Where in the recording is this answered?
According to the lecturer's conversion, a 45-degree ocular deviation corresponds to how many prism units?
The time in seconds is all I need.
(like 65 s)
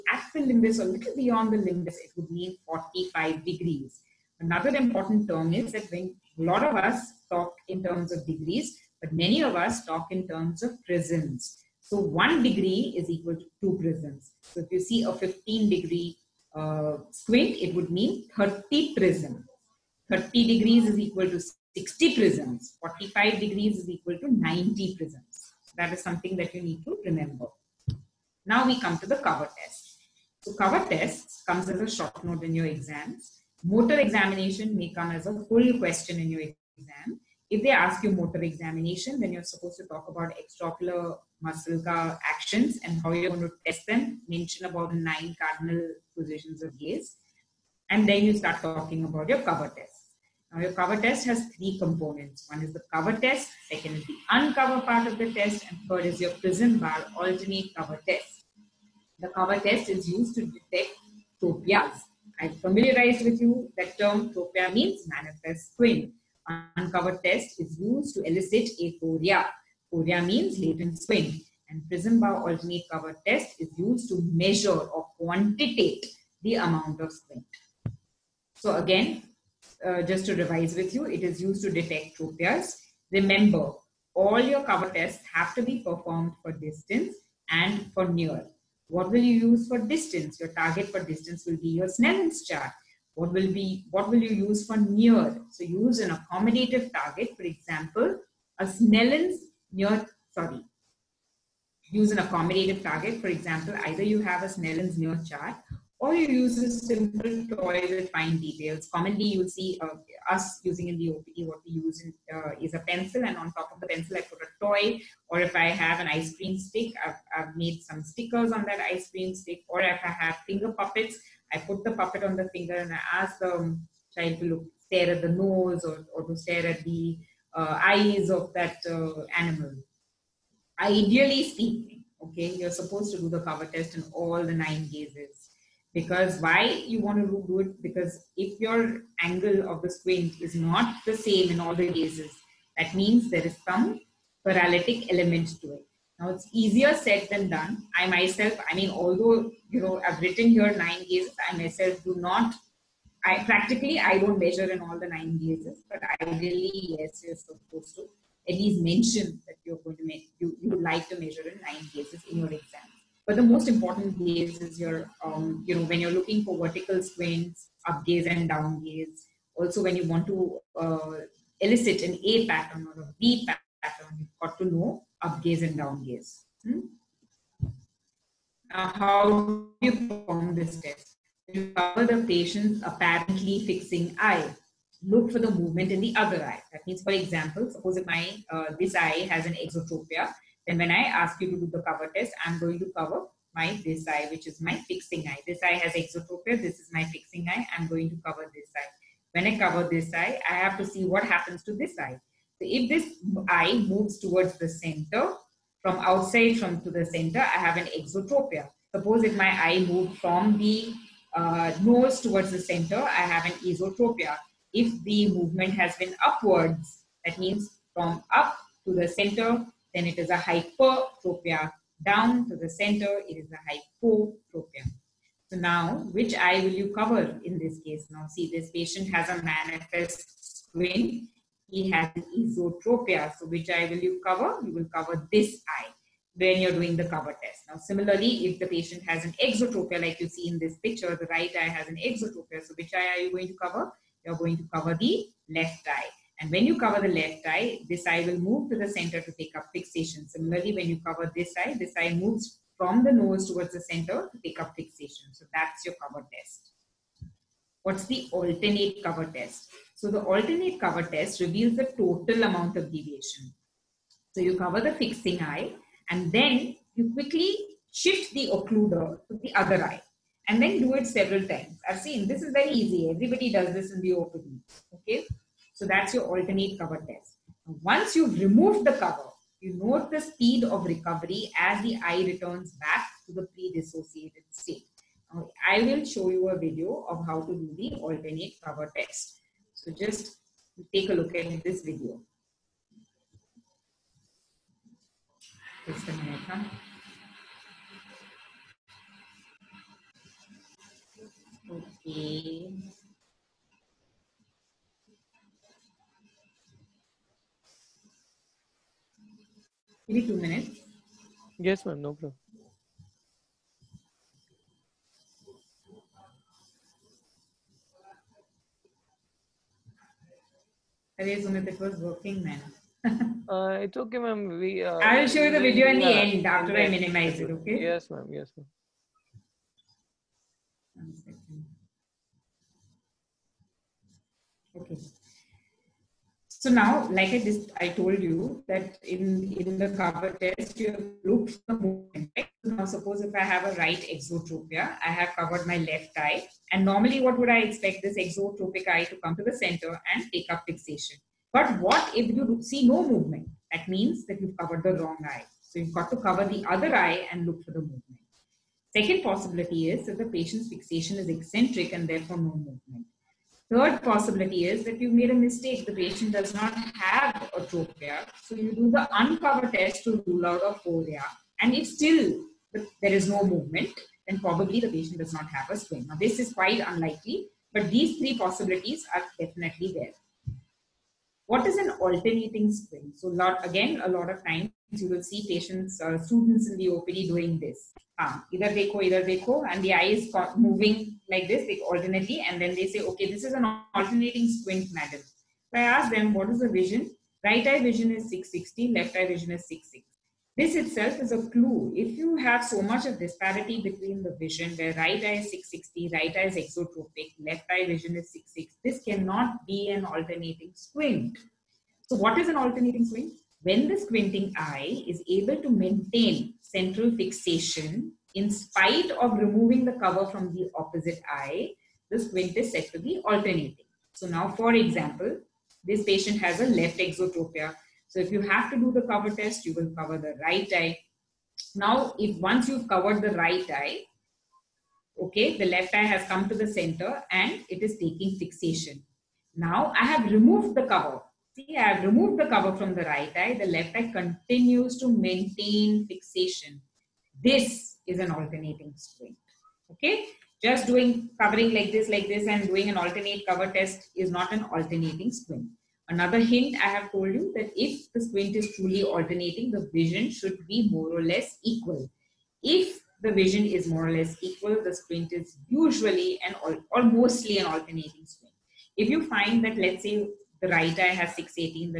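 24 s.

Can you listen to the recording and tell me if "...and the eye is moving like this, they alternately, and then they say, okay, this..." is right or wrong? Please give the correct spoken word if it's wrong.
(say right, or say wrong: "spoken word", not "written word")
right.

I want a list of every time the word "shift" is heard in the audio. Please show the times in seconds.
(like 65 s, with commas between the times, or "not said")
267 s.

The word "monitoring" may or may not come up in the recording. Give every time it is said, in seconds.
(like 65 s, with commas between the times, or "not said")
not said.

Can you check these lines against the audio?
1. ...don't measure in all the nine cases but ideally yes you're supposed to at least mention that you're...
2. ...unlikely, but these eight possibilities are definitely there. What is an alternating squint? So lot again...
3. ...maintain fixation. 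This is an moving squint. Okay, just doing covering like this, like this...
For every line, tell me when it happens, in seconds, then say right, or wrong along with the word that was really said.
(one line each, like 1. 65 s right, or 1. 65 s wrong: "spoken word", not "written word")
1. 154 s right
2. 376 s wrong: "three", not "eight"
3. 445 s wrong: "alternating", not "moving".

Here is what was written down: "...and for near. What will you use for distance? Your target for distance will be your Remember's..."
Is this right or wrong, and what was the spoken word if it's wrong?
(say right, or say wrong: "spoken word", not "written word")
wrong: "Snellen", not "Remember".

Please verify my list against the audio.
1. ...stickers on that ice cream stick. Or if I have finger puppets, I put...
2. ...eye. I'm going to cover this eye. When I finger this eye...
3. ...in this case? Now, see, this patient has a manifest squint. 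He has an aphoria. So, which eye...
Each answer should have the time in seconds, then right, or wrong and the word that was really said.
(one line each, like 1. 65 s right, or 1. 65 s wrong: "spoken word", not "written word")
1. 118 s right
2. 197 s wrong: "cover", not "finger"
3. 227 s wrong: "esotropia", not "aphoria".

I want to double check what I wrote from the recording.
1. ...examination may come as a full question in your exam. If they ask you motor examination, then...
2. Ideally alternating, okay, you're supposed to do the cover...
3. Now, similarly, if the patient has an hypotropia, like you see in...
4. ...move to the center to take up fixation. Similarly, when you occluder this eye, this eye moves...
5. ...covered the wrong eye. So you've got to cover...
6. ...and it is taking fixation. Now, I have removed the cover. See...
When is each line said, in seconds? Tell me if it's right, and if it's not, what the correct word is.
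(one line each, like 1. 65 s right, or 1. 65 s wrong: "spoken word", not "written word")
1. 33 s right
2. 130 s wrong: "speaking", not "alternating"
3. 237 s wrong: "exotropia", not "hypotropia"
4. 248 s wrong: "cover", not "occluder"
5. 354 s right
6. 437 s right.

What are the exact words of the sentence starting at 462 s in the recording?
If the vision is more or less equal, the squint is usually and or mostly an alternating squint.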